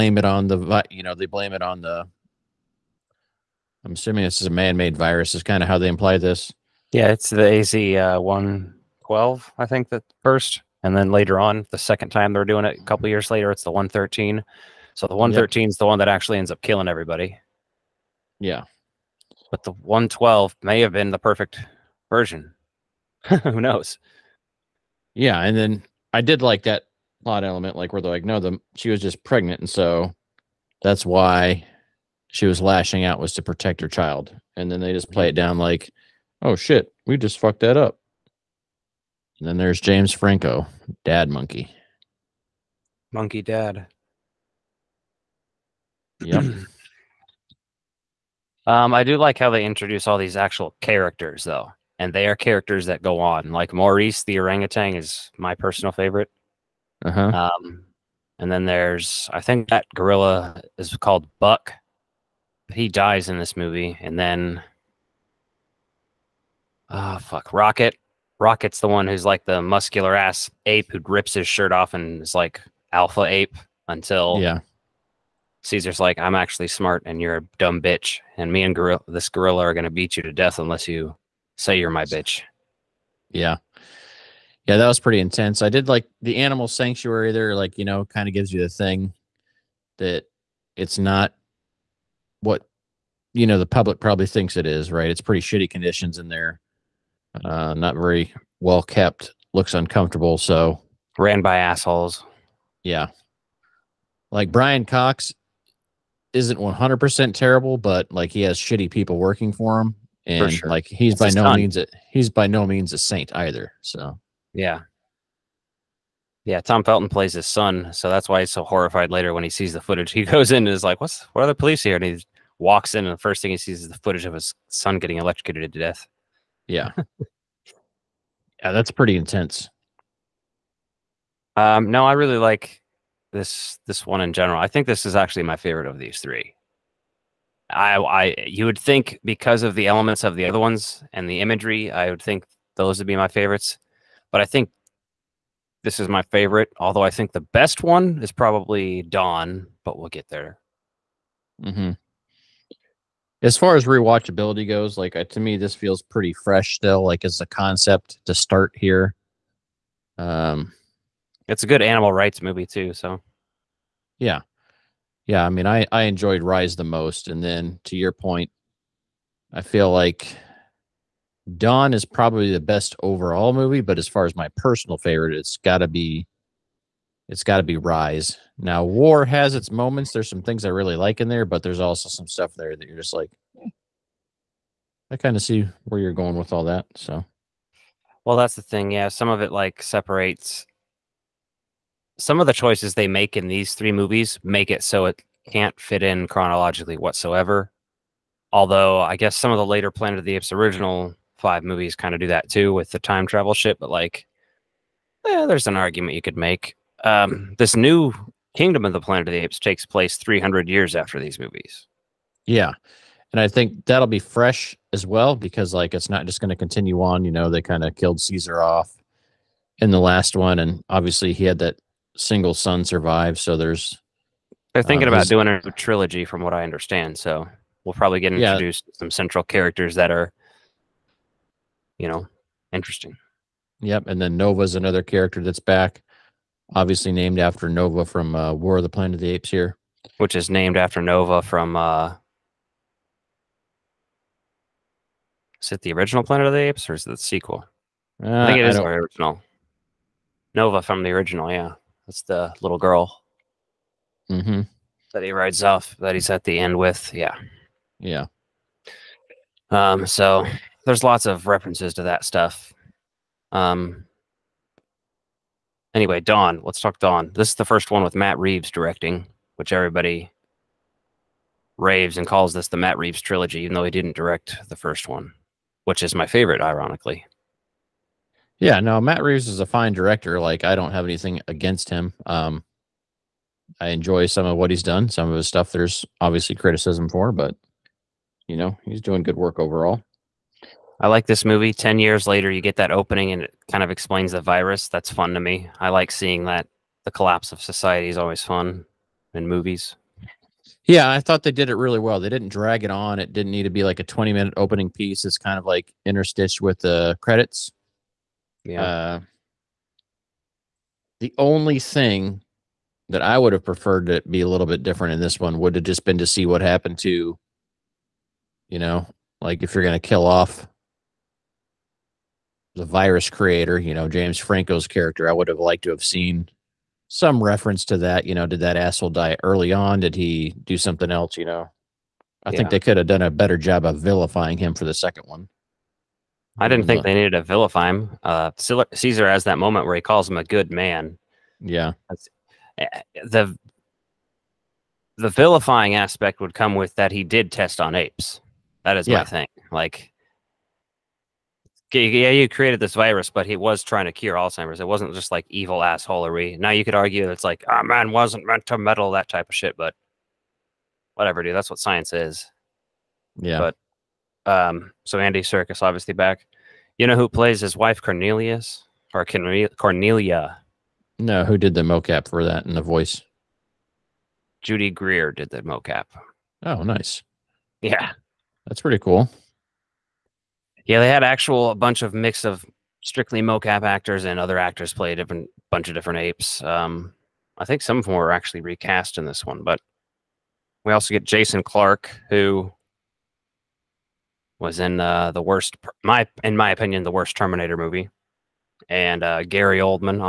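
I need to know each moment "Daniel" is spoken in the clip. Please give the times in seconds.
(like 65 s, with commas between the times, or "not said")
not said.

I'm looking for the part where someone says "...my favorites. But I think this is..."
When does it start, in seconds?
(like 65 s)
143 s.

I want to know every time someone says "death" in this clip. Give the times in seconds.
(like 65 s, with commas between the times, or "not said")
80 s, 125 s.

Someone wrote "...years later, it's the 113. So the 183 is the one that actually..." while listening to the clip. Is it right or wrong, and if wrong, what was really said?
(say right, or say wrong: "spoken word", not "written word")
wrong: "113", not "183".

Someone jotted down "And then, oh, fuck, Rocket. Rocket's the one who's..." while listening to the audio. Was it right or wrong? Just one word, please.
right.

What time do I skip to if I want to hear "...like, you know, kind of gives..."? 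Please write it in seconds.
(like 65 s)
87 s.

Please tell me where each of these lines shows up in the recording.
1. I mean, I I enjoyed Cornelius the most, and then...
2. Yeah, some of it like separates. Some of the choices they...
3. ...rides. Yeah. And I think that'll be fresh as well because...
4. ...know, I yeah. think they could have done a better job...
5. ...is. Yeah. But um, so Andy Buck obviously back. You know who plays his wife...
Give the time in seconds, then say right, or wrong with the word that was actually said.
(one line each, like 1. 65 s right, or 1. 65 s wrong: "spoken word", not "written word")
1. 165 s wrong: "Rise", not "Cornelius"
2. 188 s right
3. 211 s wrong: "movies", not "rides"
4. 331 s right
5. 362 s wrong: "Serkis", not "Buck".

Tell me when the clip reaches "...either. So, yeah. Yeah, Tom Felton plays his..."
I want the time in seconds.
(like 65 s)
113 s.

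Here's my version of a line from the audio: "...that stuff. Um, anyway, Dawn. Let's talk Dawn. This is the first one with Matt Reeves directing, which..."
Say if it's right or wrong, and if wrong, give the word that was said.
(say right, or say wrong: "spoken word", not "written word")
right.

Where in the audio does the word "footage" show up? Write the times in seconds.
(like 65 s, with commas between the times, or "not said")
119 s, 124 s.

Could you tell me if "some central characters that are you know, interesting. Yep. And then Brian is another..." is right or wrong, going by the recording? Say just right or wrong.
wrong.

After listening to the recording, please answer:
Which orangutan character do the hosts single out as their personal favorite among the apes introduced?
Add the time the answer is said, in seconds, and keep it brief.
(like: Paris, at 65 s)
Maurice, at 53 s.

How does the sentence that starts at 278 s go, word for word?
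Yeah, no, Matt Reeves is a fine director.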